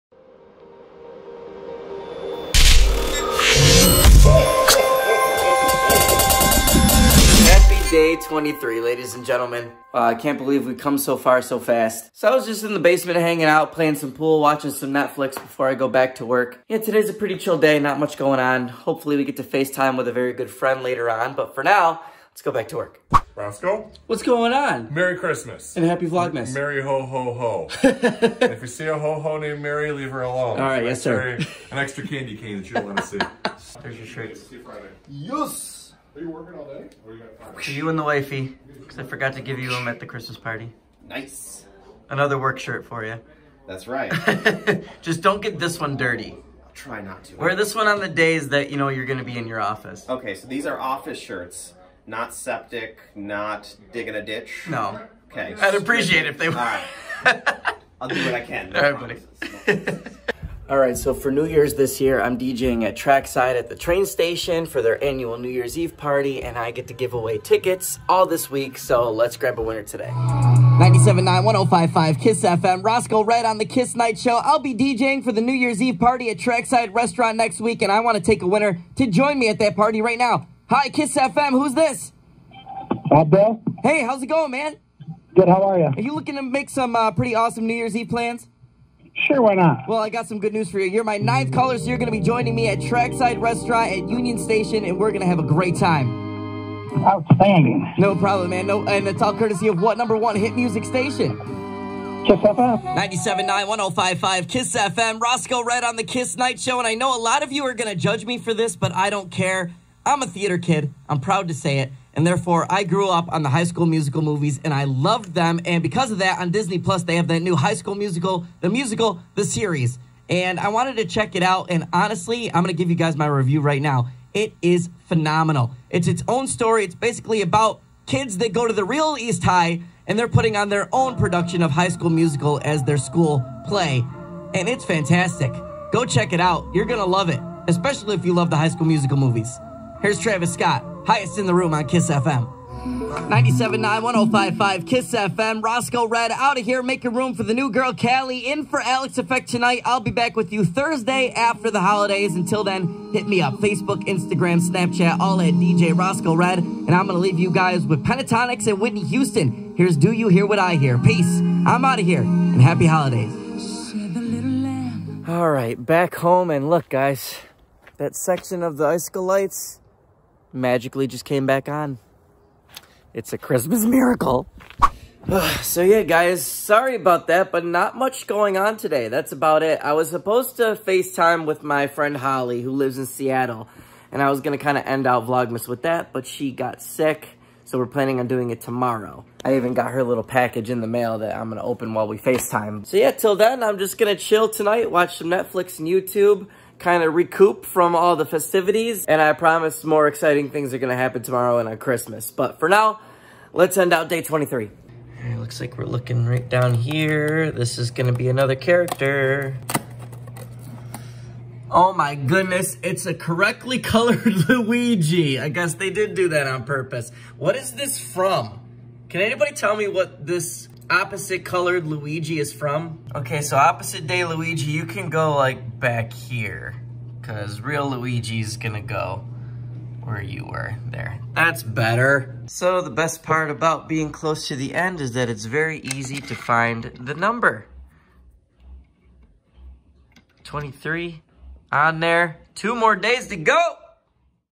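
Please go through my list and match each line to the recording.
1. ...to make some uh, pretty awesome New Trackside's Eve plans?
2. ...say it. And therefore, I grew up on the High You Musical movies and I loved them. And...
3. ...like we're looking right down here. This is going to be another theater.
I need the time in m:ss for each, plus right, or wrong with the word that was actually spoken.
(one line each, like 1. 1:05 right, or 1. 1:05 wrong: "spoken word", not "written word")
1. 1:26 wrong: "Year", not "Trackside"
2. 1:51 wrong: "School", not "You"
3. 3:25 wrong: "character", not "theater".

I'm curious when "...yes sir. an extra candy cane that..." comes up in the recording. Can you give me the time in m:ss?
0:30.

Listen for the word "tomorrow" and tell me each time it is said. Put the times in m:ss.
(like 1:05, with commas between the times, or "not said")
3:08, 3:21.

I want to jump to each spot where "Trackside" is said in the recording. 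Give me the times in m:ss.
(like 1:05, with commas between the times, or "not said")
1:02, 1:16, 1:32.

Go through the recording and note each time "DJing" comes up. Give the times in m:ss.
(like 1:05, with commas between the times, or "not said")
1:02, 1:14.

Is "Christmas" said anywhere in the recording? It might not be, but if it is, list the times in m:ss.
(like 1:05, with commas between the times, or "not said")
0:25, 0:40, 2:53, 3:21.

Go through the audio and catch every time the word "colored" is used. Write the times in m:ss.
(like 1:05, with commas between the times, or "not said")
3:33, 3:41.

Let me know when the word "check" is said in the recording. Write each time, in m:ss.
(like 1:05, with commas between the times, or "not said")
2:01, 2:16.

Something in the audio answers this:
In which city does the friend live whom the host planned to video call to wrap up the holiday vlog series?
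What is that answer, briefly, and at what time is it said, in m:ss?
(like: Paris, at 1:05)
Seattle, at 3:03.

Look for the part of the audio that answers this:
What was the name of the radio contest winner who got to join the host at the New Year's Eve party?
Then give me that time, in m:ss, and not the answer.
1:23.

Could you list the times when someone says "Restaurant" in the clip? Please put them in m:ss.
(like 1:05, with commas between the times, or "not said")
1:16, 1:33.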